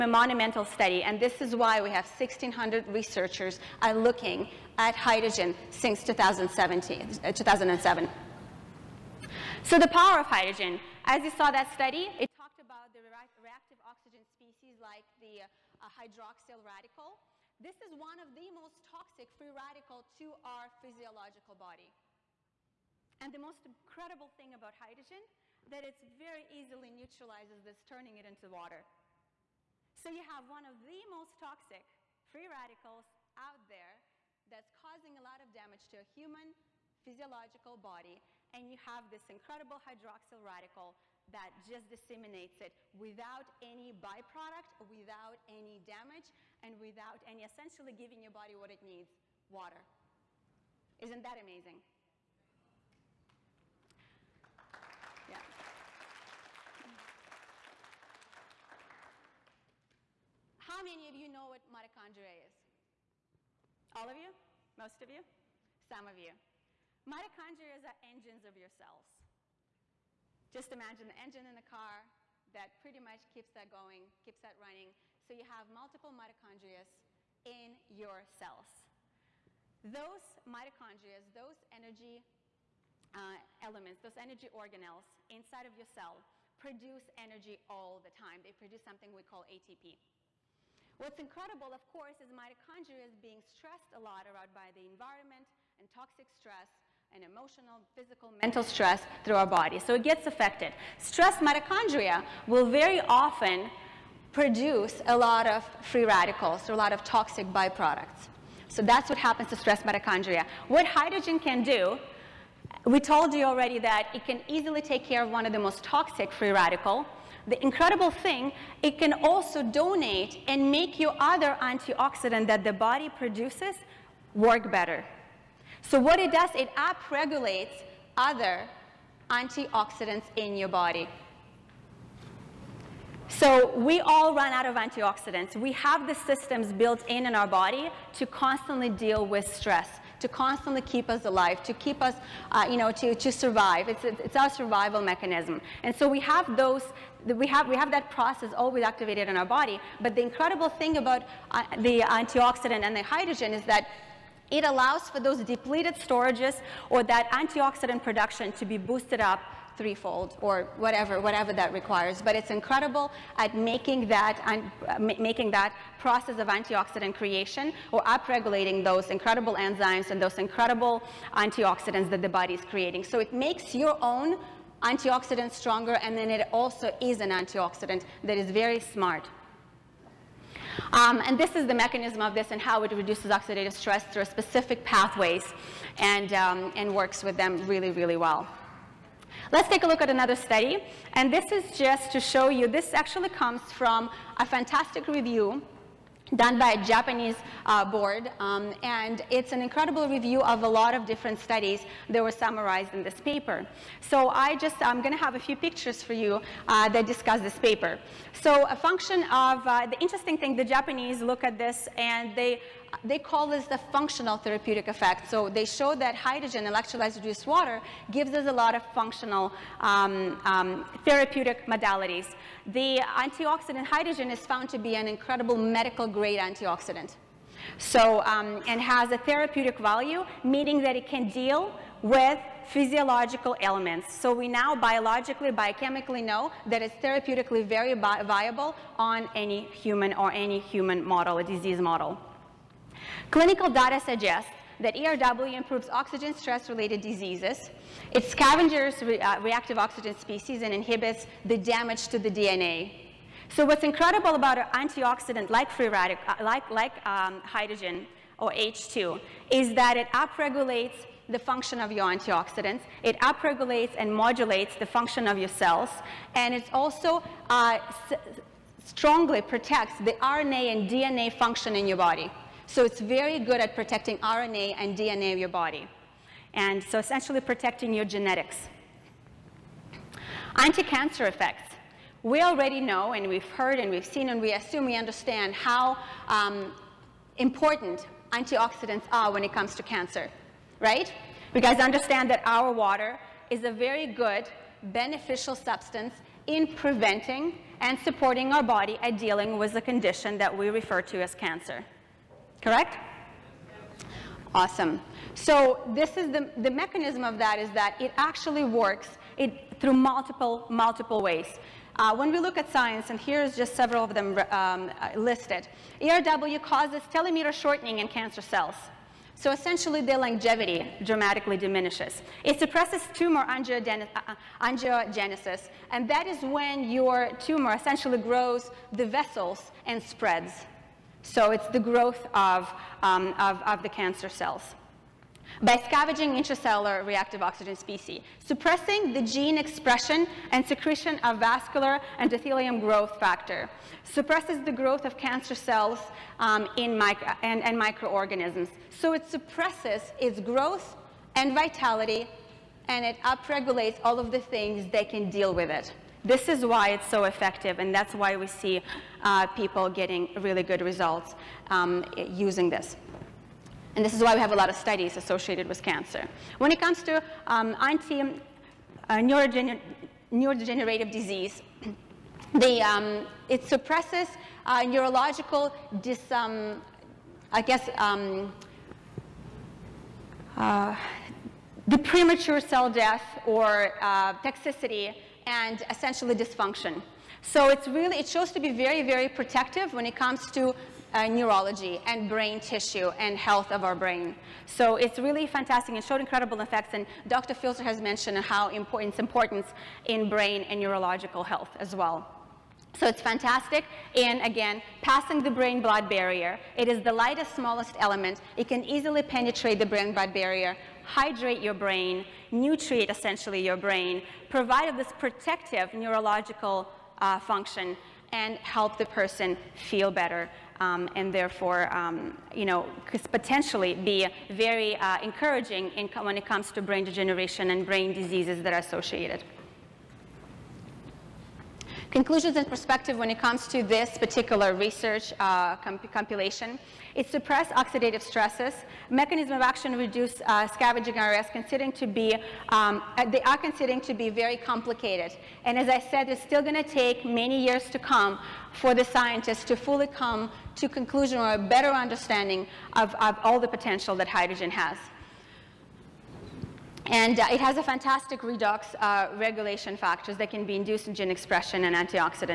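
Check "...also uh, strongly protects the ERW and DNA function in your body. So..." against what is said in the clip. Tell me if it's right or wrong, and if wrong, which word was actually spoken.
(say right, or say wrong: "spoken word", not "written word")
wrong: "RNA", not "ERW".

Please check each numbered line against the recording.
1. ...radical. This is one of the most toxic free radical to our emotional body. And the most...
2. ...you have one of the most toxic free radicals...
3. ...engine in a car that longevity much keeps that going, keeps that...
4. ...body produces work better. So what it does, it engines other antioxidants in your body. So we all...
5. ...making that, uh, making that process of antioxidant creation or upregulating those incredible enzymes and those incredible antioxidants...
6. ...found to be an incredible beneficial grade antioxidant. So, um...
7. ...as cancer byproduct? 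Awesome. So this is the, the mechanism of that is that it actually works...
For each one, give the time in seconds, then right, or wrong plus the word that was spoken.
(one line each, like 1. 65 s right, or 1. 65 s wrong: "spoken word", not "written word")
1. 16 s wrong: "physiological", not "emotional"
2. 30 s right
3. 71 s wrong: "pretty", not "longevity"
4. 122 s wrong: "upregulates", not "engines"
5. 163 s right
6. 224 s wrong: "medical", not "beneficial"
7. 301 s wrong: "correct", not "byproduct".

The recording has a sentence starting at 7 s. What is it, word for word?
Uh, so the power of hydrogen.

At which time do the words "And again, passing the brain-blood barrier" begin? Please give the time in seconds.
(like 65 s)
404 s.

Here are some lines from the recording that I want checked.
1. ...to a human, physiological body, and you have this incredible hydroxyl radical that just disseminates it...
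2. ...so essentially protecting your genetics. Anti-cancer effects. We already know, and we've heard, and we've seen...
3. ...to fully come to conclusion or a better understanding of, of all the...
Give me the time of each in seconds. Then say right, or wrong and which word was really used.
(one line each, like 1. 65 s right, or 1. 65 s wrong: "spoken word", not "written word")
1. 35 s right
2. 276 s right
3. 449 s right.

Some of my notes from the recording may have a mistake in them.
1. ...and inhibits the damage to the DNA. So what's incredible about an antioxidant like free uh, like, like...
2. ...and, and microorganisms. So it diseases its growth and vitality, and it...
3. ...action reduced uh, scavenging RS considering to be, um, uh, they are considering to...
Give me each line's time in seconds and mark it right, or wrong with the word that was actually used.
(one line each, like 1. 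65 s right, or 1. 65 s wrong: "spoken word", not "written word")
1. 250 s right
2. 347 s wrong: "suppresses", not "diseases"
3. 439 s right.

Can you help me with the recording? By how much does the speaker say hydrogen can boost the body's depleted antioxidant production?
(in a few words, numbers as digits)
threefold.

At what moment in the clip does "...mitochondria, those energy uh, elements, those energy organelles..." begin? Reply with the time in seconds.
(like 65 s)
80 s.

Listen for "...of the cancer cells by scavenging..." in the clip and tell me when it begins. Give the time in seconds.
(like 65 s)
333 s.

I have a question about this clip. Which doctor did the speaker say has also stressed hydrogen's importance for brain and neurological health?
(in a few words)
Dr. Filter.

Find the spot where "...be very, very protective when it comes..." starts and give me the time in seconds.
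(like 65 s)
388 s.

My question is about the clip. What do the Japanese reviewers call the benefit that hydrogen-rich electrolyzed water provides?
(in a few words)
functional therapeutic effect.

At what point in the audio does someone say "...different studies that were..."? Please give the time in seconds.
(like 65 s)
201 s.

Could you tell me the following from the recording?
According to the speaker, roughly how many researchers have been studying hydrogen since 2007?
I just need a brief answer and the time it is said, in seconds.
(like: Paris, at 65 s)
1,600, at 2 s.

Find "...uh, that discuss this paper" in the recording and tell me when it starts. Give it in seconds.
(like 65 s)
206 s.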